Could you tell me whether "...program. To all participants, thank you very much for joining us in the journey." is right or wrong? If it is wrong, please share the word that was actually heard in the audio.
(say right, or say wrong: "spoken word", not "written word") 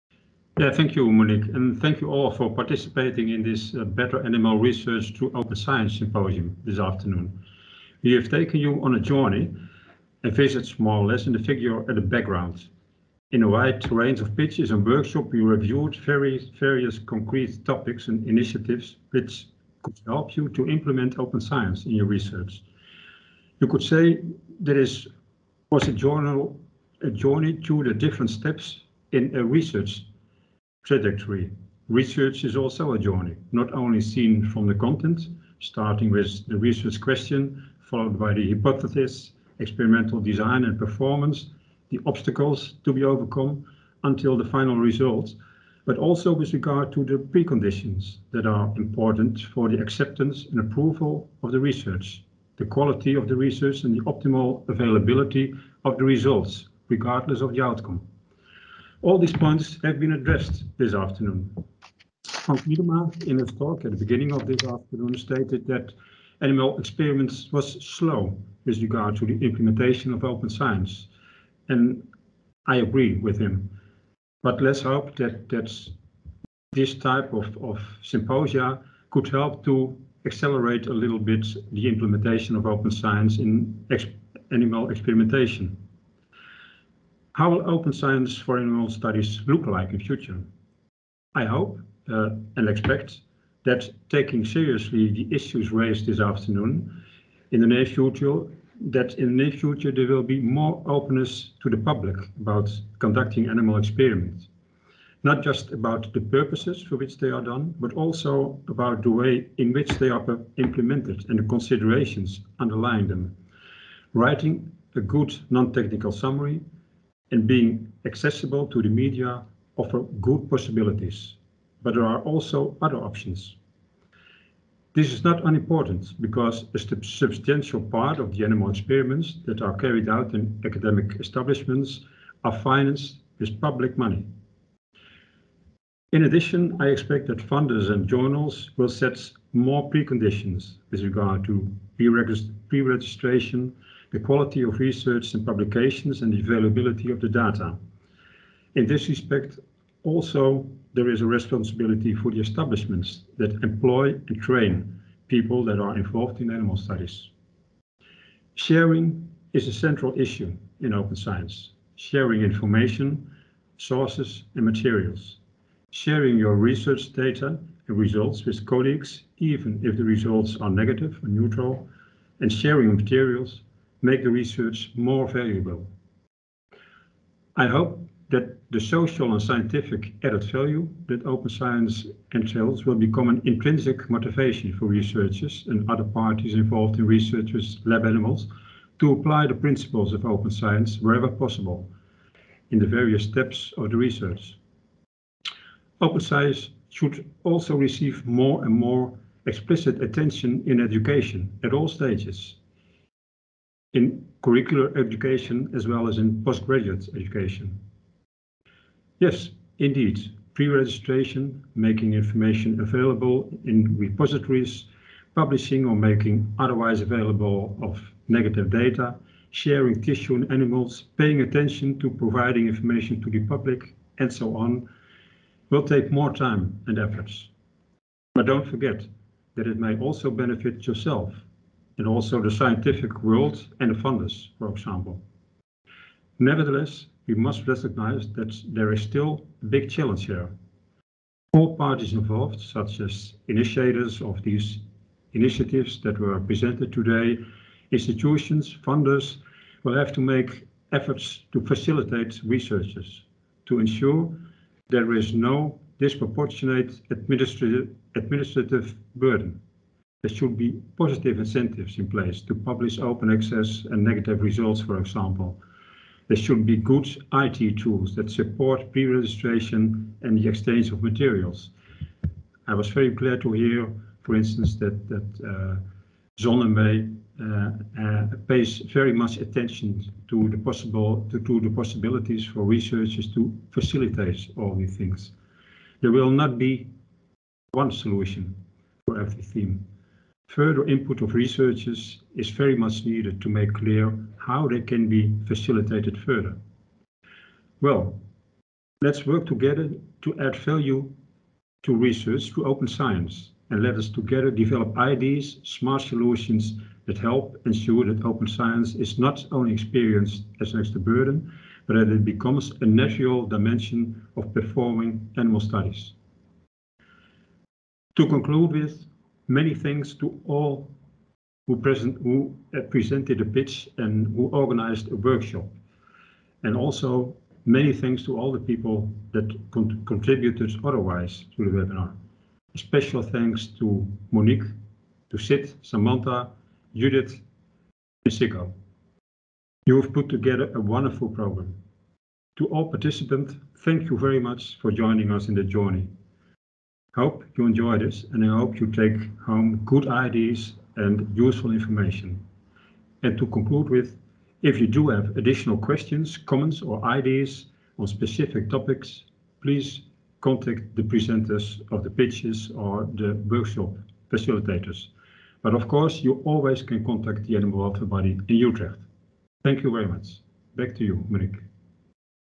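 right.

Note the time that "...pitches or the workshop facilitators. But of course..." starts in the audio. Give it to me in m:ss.
6:02.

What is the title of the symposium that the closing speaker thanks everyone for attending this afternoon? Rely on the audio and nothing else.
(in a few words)
Better Animal Research Through Open Science.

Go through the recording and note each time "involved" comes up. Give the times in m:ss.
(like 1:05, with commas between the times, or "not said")
2:35, 3:06, 4:02.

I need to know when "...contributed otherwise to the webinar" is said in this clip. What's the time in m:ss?
5:30.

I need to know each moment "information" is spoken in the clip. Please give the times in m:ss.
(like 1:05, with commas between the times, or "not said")
2:42, 3:32, 3:42, 5:51.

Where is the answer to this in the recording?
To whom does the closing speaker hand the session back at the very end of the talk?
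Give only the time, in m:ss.
6:11.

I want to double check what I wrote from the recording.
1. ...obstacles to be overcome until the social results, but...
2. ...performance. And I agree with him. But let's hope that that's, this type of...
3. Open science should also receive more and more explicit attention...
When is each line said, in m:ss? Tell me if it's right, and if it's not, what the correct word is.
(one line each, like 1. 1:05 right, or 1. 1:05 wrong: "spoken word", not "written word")
1. 0:42 wrong: "final", not "social"
2. 1:10 wrong: "science", not "performance"
3. 3:15 right.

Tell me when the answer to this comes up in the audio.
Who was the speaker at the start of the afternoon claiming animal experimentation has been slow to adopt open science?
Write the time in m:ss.
1:02.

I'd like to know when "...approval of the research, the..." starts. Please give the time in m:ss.
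0:50.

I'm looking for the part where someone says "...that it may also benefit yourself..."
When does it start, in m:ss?
3:49.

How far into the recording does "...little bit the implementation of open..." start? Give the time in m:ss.
1:20.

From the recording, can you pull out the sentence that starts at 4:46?
There will not be one solution for every theme.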